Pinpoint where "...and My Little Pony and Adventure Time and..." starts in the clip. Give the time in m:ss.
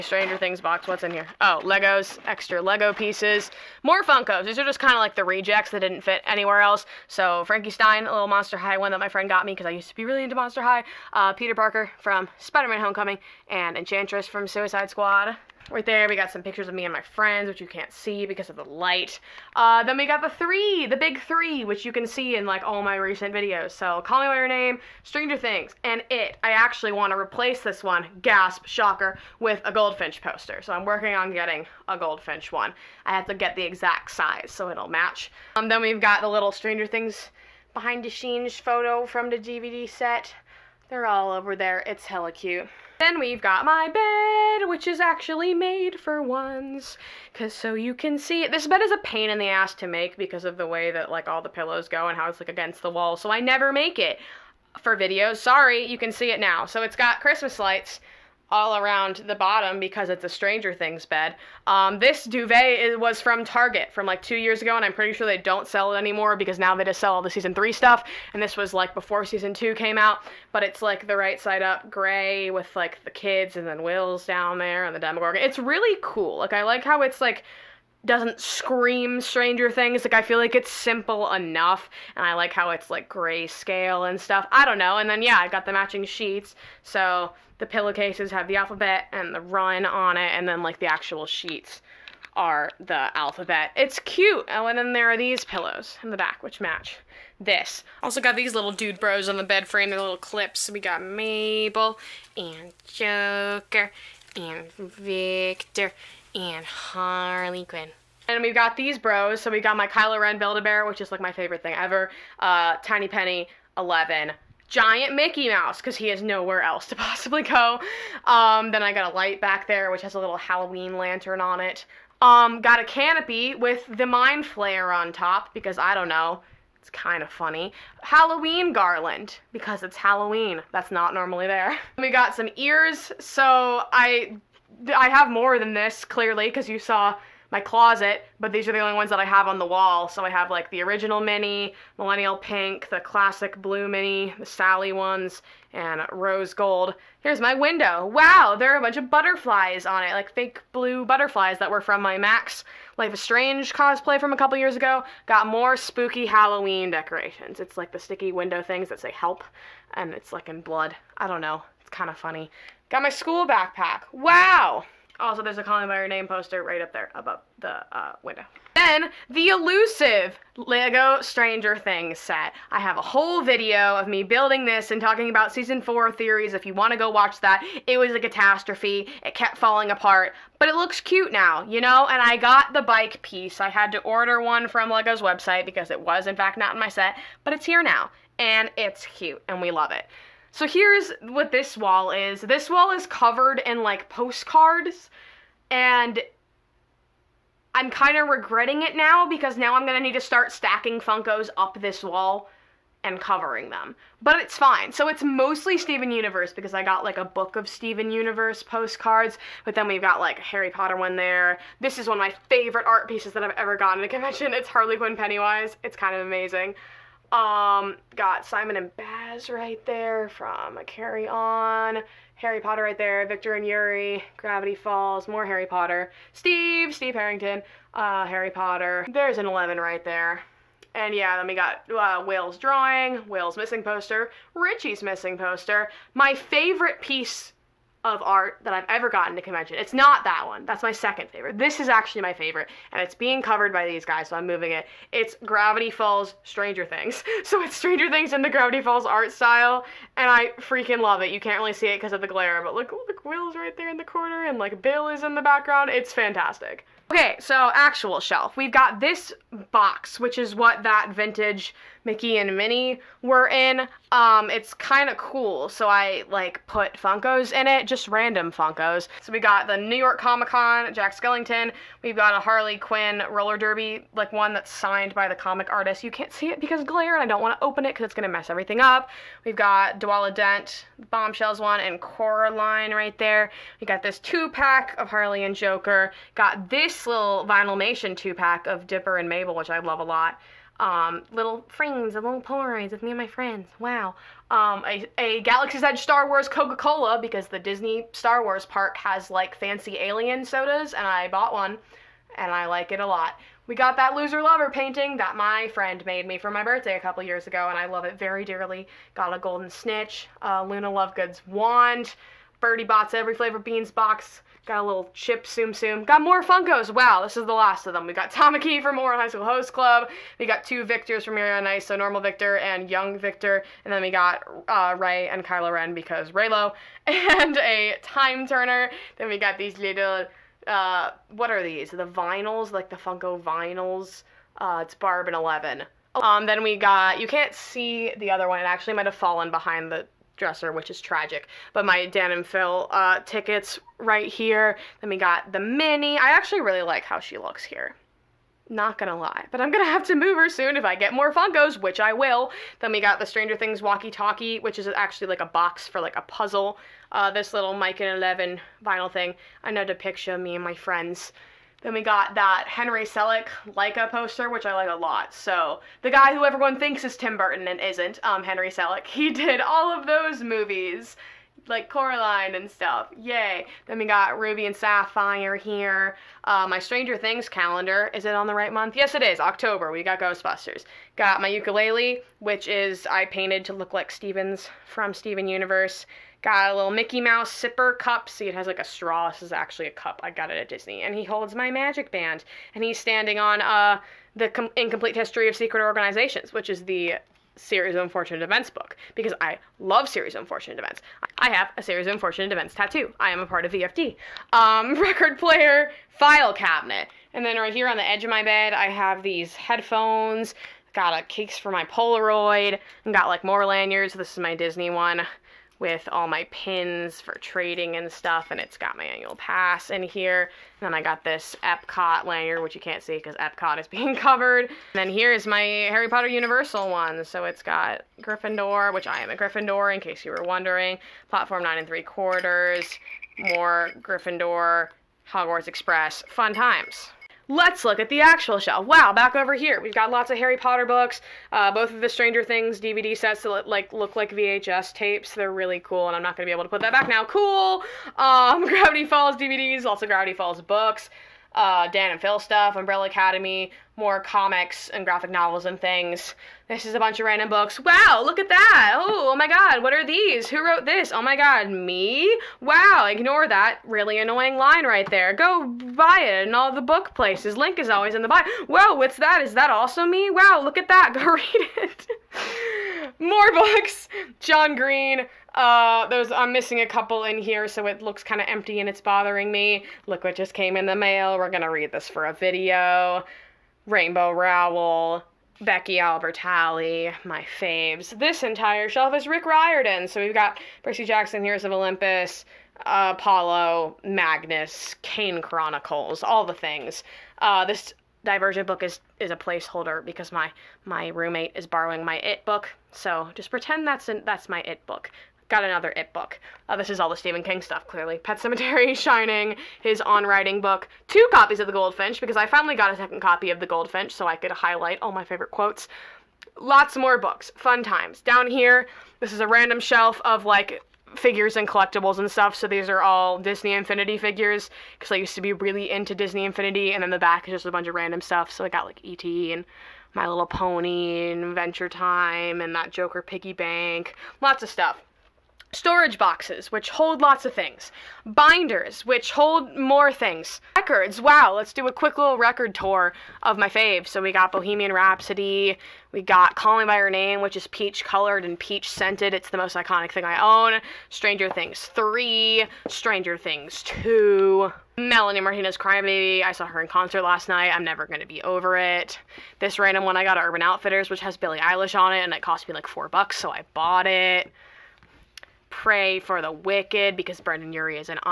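8:49.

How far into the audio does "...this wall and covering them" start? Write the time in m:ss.
3:21.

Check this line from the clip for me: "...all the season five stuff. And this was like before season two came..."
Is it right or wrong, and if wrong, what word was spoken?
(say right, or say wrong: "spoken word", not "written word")
wrong: "three", not "five".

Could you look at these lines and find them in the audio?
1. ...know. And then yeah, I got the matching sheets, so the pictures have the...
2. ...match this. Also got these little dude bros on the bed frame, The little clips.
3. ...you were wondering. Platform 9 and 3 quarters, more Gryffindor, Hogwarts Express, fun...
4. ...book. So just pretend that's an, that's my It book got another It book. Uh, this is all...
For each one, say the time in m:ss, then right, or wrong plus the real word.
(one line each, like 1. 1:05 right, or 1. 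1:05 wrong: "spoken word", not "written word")
1. 1:24 wrong: "pillowcases", not "pictures"
2. 1:36 right
3. 7:10 right
4. 8:22 right.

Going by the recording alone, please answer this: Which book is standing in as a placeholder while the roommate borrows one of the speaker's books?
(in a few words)
Divergent.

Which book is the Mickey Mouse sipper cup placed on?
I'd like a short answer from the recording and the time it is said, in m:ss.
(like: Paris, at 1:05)
Incomplete History of Secret Organizations, at 6:34.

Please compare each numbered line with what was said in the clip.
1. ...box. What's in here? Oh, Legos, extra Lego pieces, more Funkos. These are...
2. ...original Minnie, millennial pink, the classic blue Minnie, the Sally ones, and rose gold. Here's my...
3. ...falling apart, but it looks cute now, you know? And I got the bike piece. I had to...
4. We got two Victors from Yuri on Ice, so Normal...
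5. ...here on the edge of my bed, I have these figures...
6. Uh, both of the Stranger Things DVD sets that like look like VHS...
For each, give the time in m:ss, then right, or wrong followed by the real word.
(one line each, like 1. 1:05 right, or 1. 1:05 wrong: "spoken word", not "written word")
1. 0:00 right
2. 2:20 right
3. 2:59 right
4. 5:20 right
5. 6:47 wrong: "headphones", not "figures"
6. 7:21 right.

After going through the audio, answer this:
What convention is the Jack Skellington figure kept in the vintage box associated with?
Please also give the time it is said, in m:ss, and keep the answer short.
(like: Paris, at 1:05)
New York Comic-Con, at 4:29.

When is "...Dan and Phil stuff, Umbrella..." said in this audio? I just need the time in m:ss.
7:31.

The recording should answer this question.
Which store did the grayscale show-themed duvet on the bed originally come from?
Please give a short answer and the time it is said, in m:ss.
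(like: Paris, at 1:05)
Target, at 1:03.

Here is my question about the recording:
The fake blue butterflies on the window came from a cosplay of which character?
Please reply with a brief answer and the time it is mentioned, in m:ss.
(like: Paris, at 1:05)
Max, at 2:32.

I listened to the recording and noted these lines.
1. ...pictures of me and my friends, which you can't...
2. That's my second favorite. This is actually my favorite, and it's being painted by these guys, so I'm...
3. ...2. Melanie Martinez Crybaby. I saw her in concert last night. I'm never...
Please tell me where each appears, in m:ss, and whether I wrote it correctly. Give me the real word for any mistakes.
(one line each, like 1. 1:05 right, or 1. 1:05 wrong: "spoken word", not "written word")
1. 0:16 right
2. 4:00 wrong: "covered", not "painted"
3. 9:13 right.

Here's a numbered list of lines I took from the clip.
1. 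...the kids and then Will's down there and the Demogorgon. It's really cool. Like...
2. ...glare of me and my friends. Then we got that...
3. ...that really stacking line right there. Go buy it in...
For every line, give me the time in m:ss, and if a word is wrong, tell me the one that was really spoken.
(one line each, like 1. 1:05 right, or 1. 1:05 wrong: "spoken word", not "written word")
1. 1:13 right
2. 5:59 wrong: "picture", not "glare"
3. 7:43 wrong: "annoying", not "stacking".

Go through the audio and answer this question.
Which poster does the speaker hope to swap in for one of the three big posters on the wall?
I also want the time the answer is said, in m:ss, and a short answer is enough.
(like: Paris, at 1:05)
Goldfinch poster, at 0:29.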